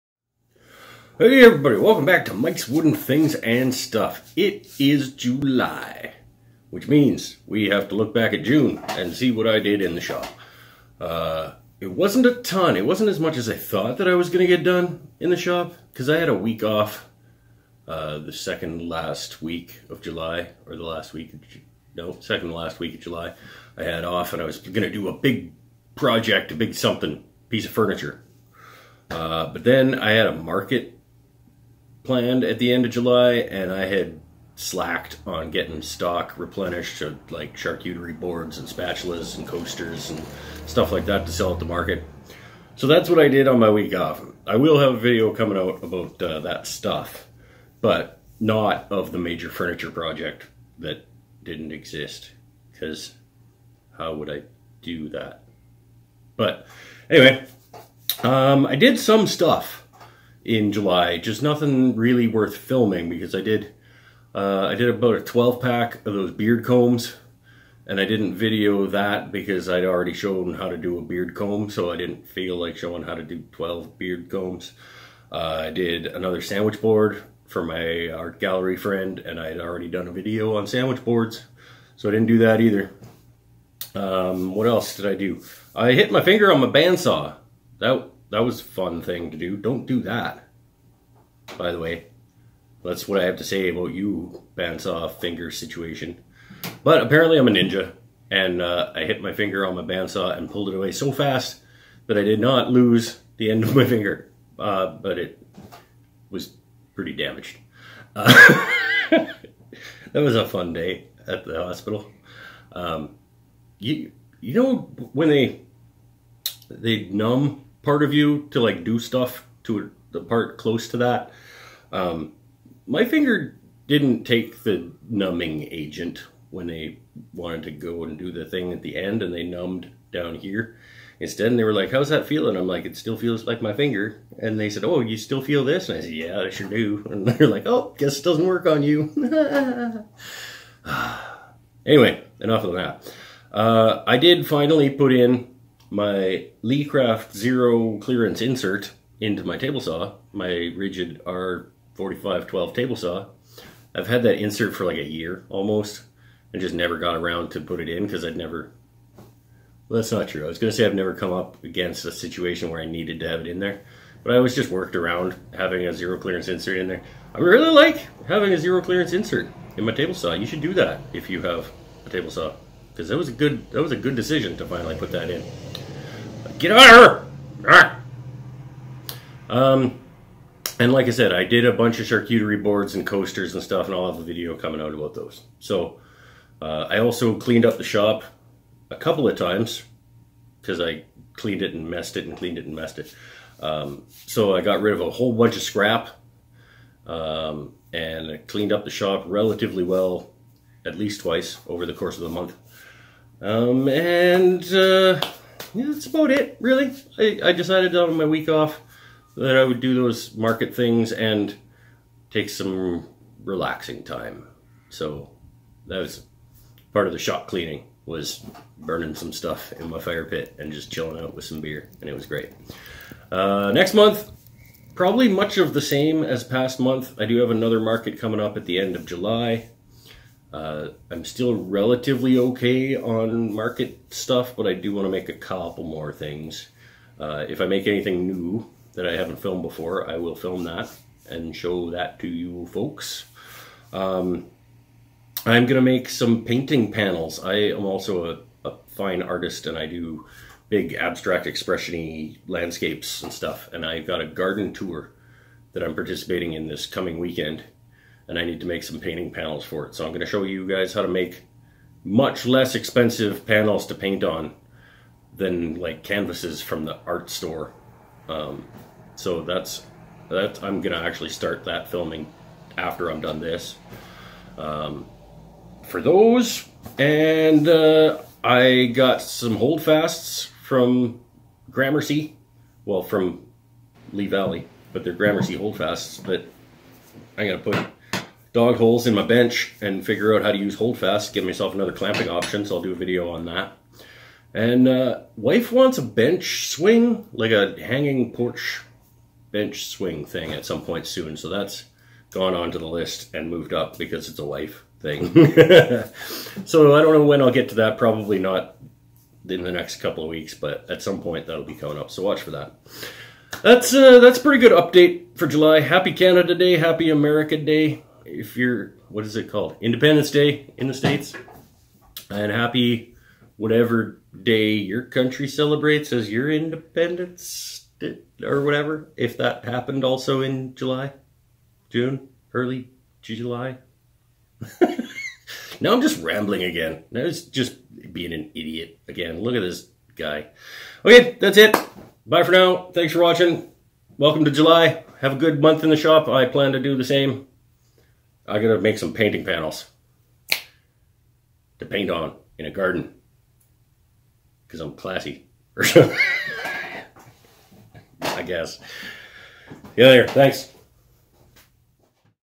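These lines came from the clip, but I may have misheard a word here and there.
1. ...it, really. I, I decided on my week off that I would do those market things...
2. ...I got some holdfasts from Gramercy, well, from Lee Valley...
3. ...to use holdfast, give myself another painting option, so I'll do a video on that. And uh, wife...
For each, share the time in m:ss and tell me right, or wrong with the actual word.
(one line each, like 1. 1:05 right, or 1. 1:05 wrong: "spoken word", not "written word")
1. 3:26 right
2. 4:38 right
3. 4:50 wrong: "clamping", not "painting".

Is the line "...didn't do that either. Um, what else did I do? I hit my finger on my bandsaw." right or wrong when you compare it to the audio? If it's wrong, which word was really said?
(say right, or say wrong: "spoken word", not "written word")
right.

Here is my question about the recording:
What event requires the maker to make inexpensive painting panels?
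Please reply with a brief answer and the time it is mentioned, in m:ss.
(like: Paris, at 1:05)
Garden tour, at 4:14.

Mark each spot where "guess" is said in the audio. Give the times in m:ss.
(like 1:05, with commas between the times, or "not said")
2:17, 5:58.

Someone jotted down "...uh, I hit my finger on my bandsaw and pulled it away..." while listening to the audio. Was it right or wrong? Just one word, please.
right.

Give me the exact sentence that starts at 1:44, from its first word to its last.
Uh, but it was pretty damaged.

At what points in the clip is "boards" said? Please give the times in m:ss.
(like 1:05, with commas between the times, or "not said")
0:38, 1:16, 1:21, 3:02.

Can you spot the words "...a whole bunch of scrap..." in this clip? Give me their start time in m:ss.
3:15.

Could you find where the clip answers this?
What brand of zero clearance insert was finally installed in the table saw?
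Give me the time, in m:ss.
2:26.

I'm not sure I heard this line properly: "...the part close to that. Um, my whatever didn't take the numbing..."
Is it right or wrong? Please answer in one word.
wrong.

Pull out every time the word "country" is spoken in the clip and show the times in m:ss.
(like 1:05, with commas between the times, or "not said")
5:25.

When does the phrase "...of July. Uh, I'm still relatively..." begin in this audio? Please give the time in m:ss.
3:48.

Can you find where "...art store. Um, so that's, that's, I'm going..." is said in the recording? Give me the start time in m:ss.
4:27.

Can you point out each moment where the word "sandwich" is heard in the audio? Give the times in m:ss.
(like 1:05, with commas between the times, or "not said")
1:16, 1:20.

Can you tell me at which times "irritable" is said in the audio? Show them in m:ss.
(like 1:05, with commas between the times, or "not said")
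not said.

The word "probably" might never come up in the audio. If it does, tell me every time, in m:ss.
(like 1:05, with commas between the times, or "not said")
3:44, 5:07.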